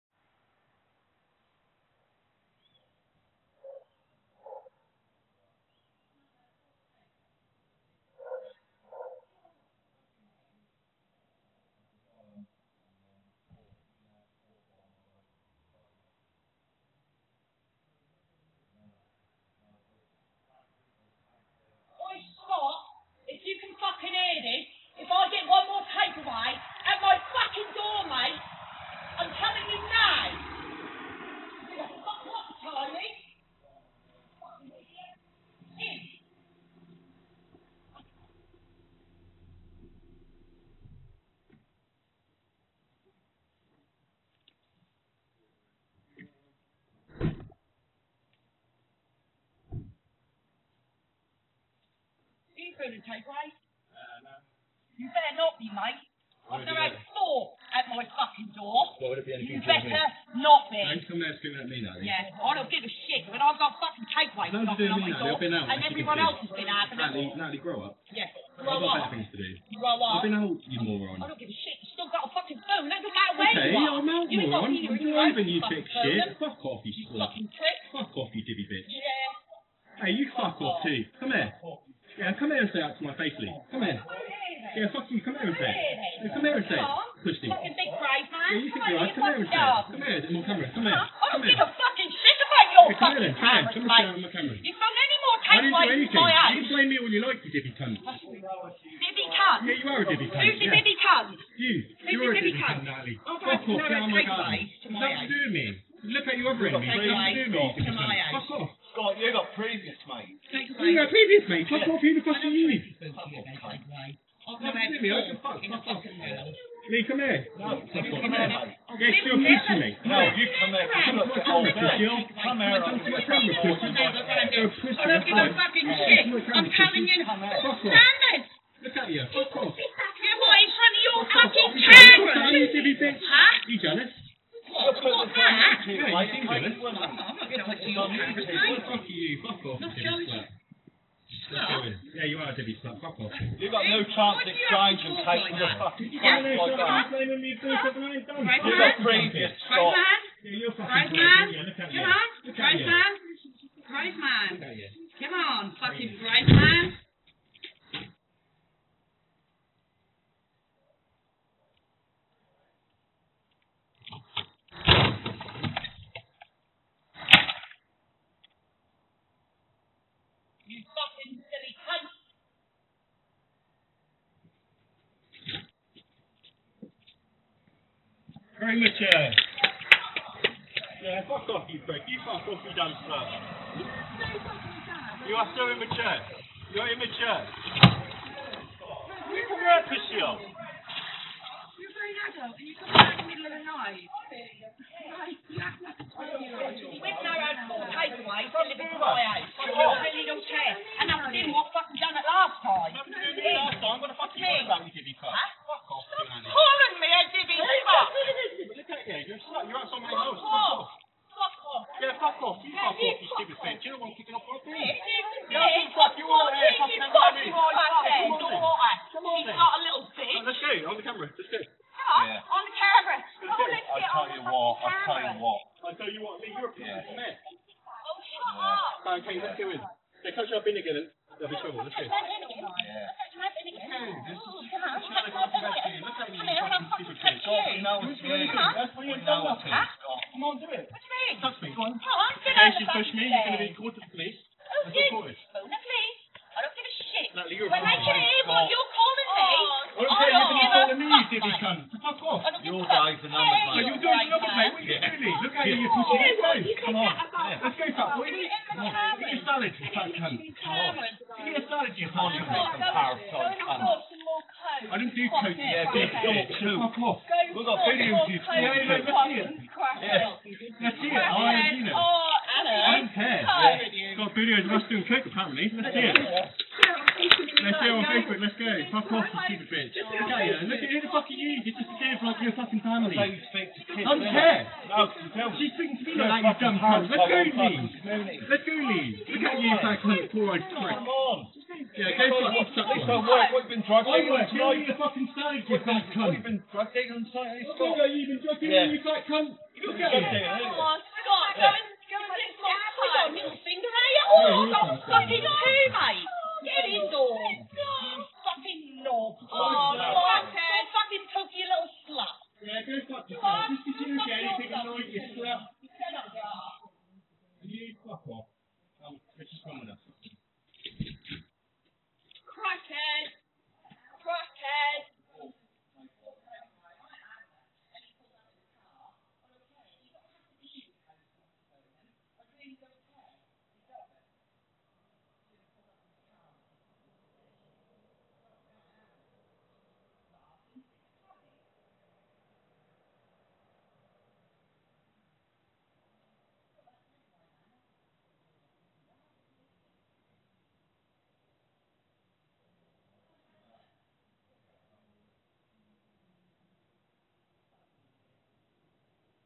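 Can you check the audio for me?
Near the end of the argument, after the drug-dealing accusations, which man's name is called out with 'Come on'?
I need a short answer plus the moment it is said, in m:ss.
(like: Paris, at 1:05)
Scott, at 5:00.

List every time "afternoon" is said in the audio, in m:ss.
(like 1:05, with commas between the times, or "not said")
not said.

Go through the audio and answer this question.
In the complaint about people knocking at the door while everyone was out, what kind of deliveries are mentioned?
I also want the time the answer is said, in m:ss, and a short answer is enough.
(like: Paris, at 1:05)
takeaways, at 1:04.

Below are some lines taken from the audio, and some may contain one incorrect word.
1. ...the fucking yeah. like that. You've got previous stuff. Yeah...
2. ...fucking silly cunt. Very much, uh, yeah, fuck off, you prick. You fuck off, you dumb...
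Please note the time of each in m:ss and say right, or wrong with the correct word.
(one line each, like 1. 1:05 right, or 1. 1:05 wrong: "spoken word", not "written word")
1. 2:25 right
2. 2:50 right.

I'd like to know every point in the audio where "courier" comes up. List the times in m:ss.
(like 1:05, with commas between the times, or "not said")
not said.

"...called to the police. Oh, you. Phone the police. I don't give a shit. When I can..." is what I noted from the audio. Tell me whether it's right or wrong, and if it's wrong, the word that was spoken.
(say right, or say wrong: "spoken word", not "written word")
right.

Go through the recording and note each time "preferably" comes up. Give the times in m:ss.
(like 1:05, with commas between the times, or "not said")
not said.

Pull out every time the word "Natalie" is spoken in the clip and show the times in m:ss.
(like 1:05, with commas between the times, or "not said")
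1:06, 1:42.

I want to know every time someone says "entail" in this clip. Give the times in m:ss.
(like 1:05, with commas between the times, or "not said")
not said.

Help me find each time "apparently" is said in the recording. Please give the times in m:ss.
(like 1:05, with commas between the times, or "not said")
4:35.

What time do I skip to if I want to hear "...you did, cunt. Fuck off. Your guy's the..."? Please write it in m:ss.
4:11.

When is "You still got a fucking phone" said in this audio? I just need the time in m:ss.
1:11.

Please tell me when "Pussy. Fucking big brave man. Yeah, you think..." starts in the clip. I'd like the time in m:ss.
1:27.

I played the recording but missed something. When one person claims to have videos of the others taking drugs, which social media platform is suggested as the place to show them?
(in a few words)
Facebook.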